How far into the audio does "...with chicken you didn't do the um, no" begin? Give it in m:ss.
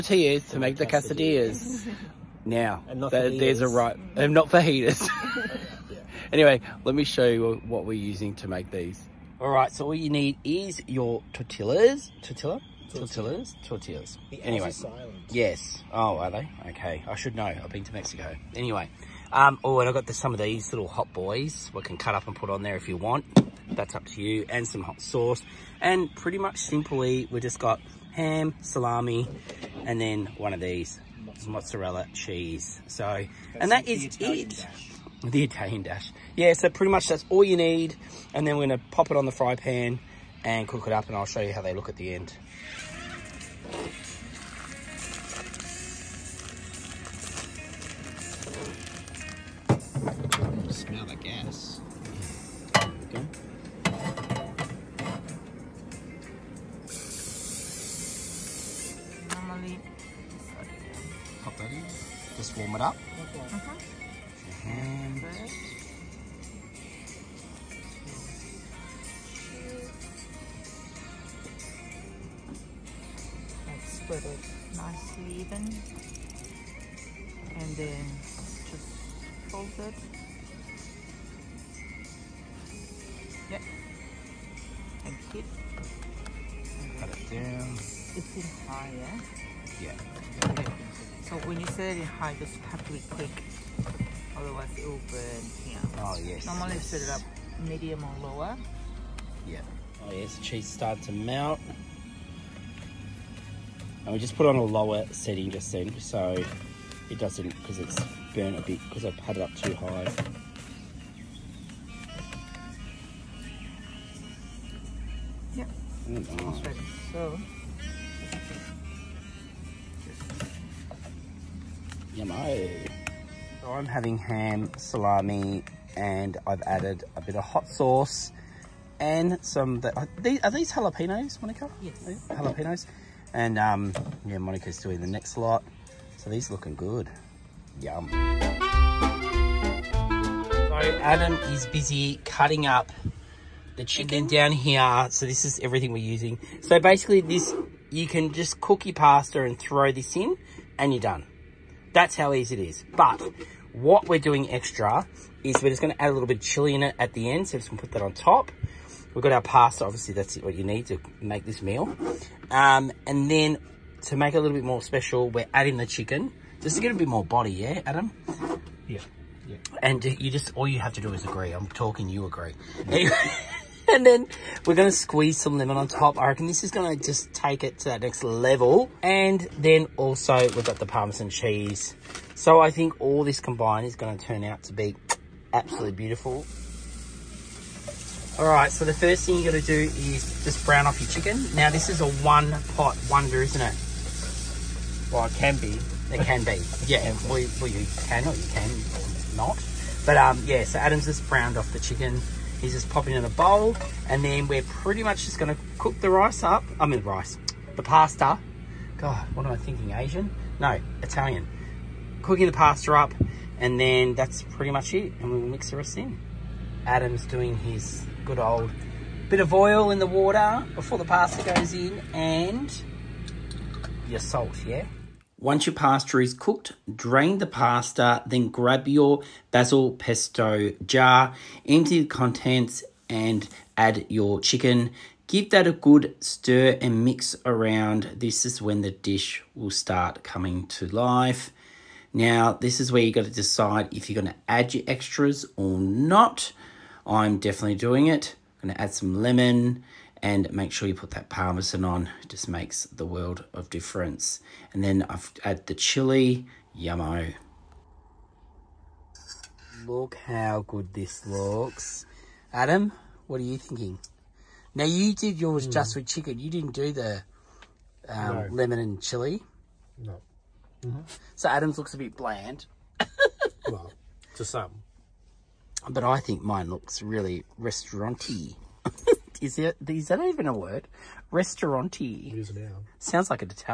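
4:25.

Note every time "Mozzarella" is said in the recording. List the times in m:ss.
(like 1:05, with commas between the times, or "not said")
0:31.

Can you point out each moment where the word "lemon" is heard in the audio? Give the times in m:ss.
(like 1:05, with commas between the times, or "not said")
2:55, 4:09, 4:28.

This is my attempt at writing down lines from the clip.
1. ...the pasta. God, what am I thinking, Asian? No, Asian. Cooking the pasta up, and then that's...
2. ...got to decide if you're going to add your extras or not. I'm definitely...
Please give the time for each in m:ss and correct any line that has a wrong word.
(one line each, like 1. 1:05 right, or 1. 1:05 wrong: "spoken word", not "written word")
1. 3:27 wrong: "Italian", not "Asian"
2. 4:03 right.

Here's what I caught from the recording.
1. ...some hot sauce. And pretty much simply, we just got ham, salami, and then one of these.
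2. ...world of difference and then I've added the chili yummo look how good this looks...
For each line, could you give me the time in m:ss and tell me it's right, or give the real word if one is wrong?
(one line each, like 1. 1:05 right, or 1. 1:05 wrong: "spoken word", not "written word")
1. 0:24 right
2. 4:13 right.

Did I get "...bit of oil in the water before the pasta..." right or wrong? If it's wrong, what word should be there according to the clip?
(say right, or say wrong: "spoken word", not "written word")
right.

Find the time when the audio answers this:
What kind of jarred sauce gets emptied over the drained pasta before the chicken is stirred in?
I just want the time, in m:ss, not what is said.
3:49.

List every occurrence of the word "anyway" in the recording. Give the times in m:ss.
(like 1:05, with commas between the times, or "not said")
0:06, 0:14, 0:18.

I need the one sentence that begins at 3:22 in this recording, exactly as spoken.
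He's just popping in a bowl.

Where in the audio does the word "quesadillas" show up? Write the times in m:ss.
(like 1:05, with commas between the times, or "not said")
0:00.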